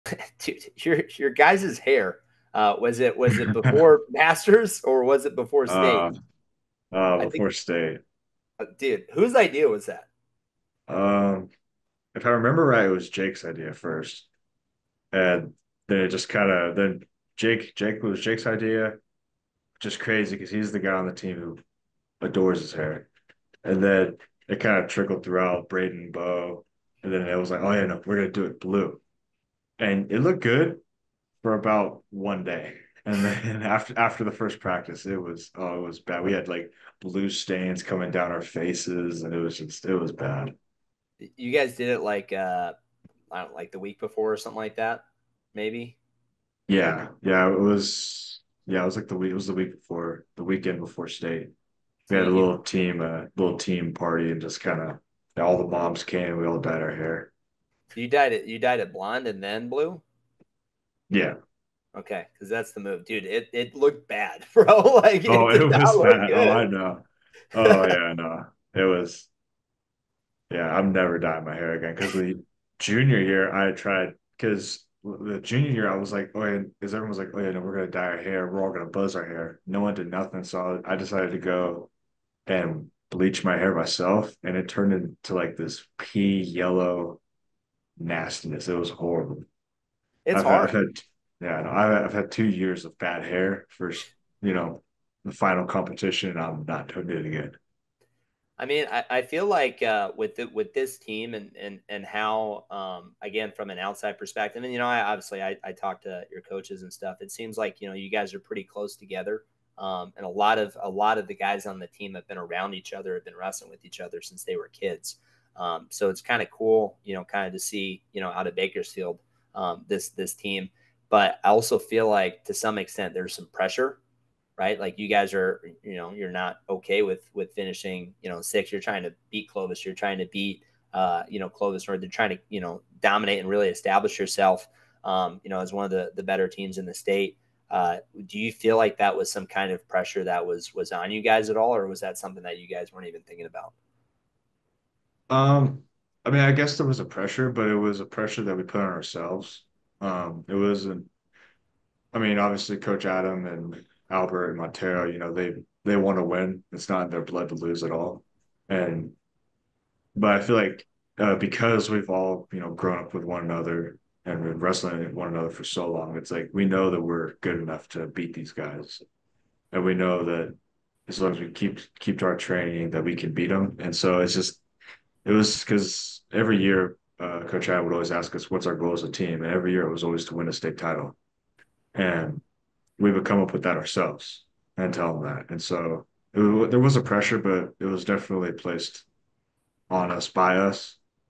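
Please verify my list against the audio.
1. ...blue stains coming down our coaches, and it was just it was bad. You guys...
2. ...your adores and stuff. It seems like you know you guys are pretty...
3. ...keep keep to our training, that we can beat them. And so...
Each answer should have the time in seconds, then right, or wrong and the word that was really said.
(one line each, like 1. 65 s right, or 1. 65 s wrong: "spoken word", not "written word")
1. 37 s wrong: "faces", not "coaches"
2. 106 s wrong: "coaches", not "adores"
3. 171 s right.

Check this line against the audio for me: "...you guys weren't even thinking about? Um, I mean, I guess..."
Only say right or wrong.
right.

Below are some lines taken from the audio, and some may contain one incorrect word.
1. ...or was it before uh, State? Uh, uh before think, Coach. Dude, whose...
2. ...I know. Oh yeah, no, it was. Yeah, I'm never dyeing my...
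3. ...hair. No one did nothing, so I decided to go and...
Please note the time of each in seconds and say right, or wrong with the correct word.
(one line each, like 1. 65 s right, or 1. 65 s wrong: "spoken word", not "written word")
1. 4 s wrong: "State", not "Coach"
2. 66 s right
3. 79 s right.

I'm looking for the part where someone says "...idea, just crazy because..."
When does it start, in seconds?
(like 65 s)
18 s.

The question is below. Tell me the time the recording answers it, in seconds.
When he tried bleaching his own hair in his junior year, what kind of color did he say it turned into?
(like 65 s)
85 s.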